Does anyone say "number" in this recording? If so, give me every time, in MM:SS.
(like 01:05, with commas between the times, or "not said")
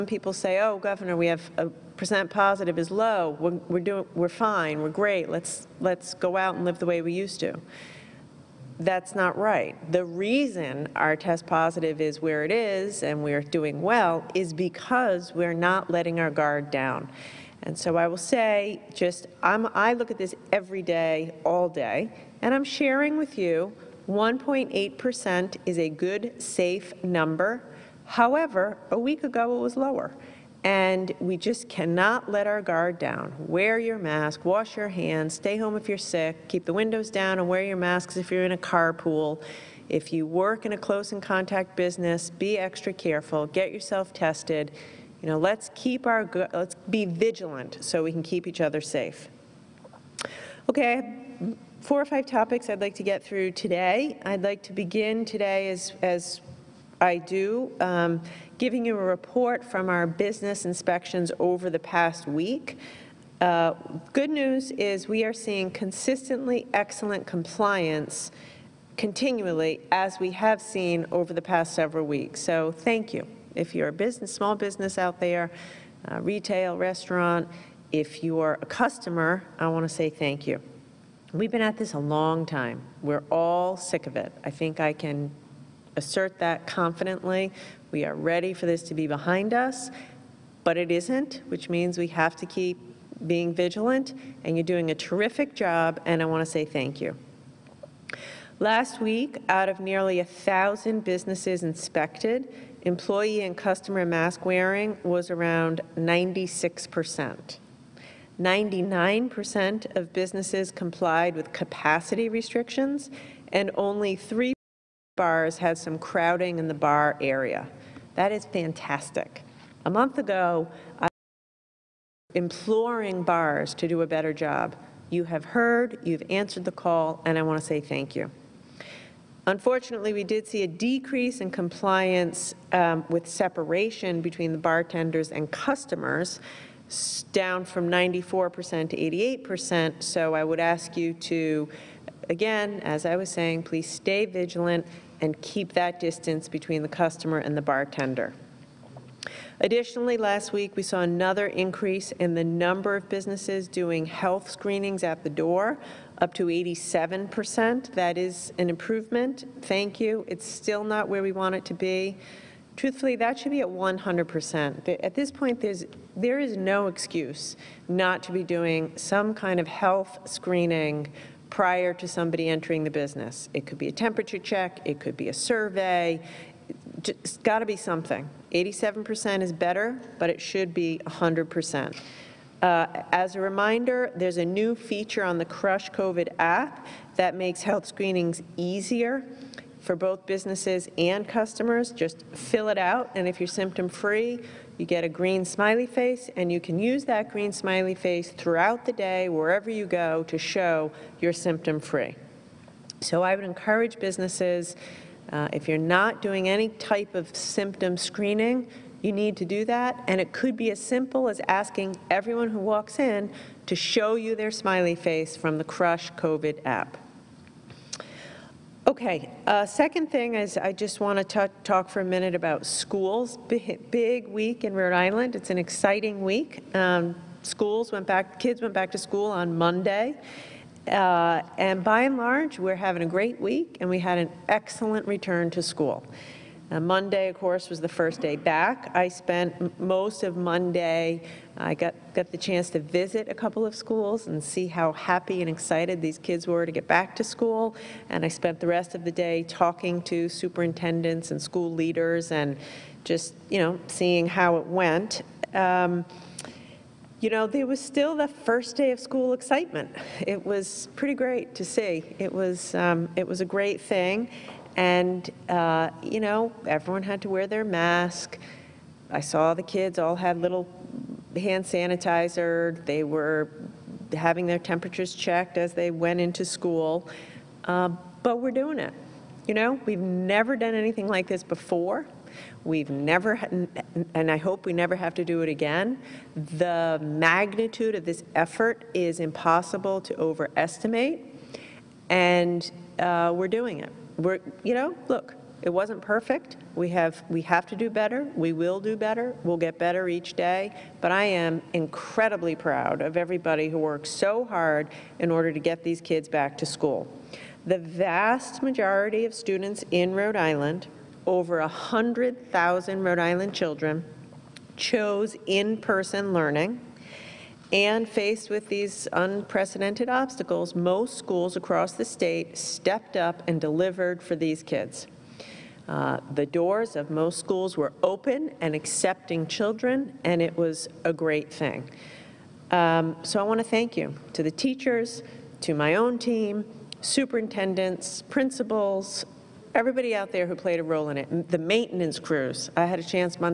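00:27, 02:32.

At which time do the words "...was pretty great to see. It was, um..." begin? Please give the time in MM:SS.
04:20.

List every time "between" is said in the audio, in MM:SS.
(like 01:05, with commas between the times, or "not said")
02:14, 02:26.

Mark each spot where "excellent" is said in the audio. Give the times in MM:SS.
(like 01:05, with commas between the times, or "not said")
01:06, 03:54.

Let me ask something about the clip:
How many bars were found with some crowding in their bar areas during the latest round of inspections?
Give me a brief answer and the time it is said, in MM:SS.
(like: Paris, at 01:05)
3, at 01:54.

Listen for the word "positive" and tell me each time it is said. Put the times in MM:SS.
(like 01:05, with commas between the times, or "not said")
00:02, 00:11.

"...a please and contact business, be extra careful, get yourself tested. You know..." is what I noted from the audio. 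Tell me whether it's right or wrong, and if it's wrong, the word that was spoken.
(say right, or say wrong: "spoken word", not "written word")
wrong: "close", not "please".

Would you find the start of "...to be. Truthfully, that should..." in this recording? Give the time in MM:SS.
02:41.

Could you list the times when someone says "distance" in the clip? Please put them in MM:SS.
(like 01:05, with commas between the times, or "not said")
02:25.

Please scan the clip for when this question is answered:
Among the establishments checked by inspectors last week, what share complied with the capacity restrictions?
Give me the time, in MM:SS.
01:48.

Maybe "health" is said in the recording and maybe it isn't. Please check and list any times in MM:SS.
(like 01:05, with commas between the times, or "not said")
02:34, 02:49, 03:07.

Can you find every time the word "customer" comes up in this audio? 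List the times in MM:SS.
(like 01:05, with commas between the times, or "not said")
01:18, 01:43, 02:15, 02:26, 03:11.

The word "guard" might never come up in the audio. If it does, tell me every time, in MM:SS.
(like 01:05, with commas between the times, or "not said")
00:16, 00:32.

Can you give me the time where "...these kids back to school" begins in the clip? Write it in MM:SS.
05:05.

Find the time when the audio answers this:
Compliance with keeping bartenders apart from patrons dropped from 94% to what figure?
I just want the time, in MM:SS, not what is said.
02:18.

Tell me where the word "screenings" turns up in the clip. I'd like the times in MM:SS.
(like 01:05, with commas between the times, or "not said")
02:34, 02:50, 03:07, 03:27.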